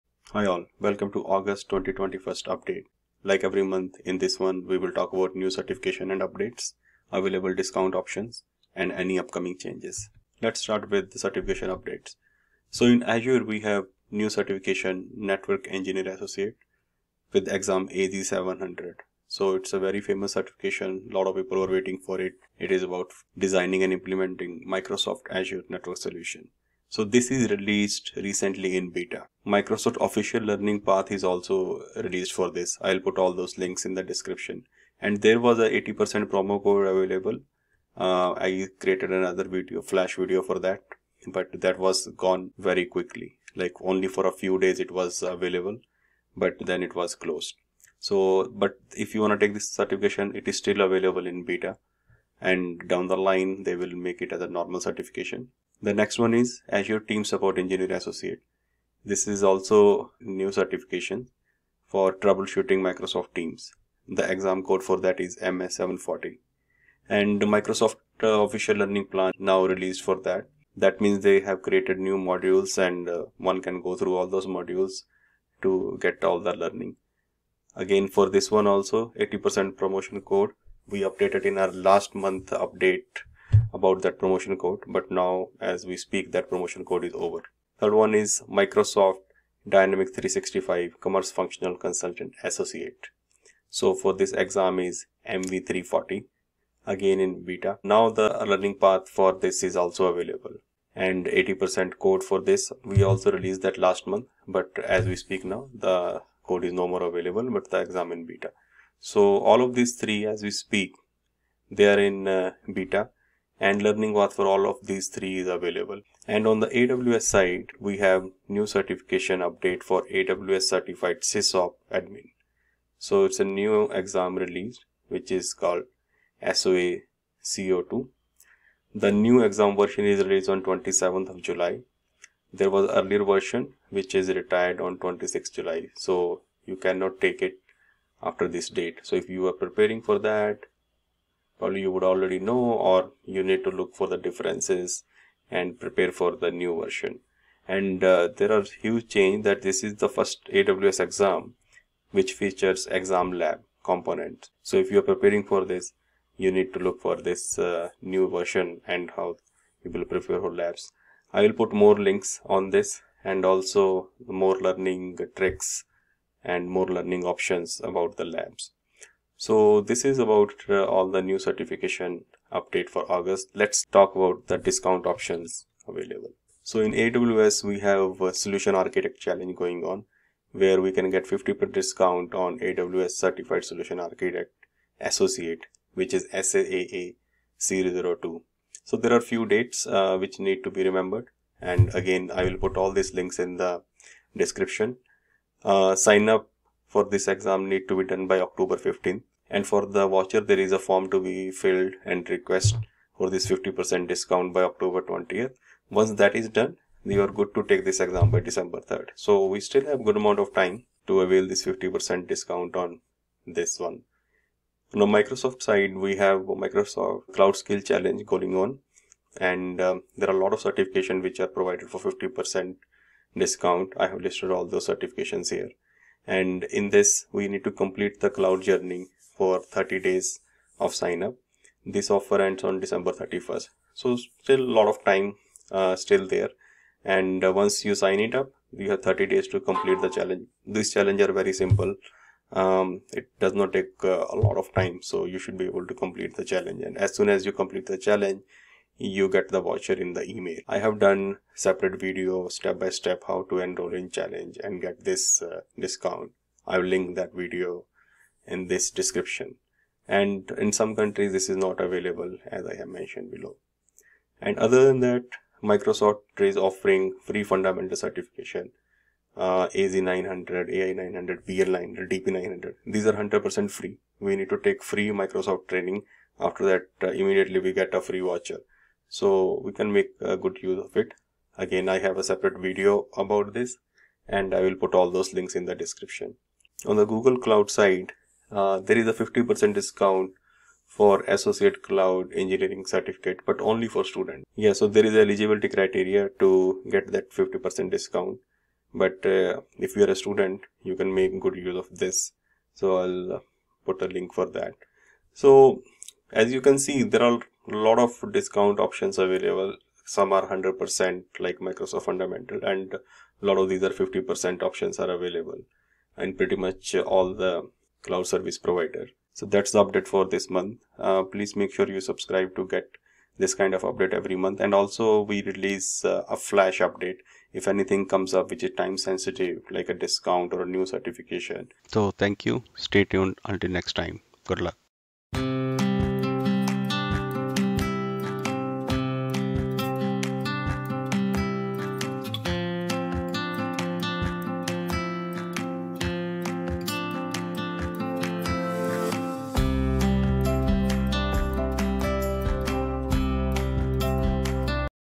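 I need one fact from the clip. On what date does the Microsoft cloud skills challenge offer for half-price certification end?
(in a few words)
December 31st.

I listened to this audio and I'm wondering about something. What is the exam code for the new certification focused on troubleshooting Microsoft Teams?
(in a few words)
MS-740.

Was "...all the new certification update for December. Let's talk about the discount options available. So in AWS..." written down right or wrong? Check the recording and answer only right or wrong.
wrong.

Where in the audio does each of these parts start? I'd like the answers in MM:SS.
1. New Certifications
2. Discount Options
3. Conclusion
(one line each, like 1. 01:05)
1. 00:12
2. 02:56
3. 05:20.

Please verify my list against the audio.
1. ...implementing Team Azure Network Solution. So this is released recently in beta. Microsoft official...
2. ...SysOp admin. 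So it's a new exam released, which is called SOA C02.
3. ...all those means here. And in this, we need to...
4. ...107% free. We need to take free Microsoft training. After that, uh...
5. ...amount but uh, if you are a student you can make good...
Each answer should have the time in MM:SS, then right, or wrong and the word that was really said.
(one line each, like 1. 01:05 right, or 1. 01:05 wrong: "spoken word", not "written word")
1. 00:23 wrong: "Microsoft", not "Team"
2. 02:01 right
3. 03:44 wrong: "certifications", not "means"
4. 04:33 wrong: "100", not "107"
5. 04:57 wrong: "discount", not "amount".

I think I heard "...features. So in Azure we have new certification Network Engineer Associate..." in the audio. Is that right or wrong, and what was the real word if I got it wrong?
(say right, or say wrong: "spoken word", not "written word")
wrong: "updates", not "features".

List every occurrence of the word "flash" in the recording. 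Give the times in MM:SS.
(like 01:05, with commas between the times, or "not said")
00:39, 05:26.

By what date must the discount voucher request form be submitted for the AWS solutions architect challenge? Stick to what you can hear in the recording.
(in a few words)
October 20th.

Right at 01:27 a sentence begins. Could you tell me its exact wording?
Third one is Microsoft Dynamics 365 Commerce Functional Consultant Associate.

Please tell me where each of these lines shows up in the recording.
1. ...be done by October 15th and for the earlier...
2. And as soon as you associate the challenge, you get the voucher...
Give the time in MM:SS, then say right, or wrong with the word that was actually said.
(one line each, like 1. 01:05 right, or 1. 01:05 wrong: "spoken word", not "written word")
1. 03:17 wrong: "voucher", not "earlier"
2. 04:06 wrong: "complete", not "associate".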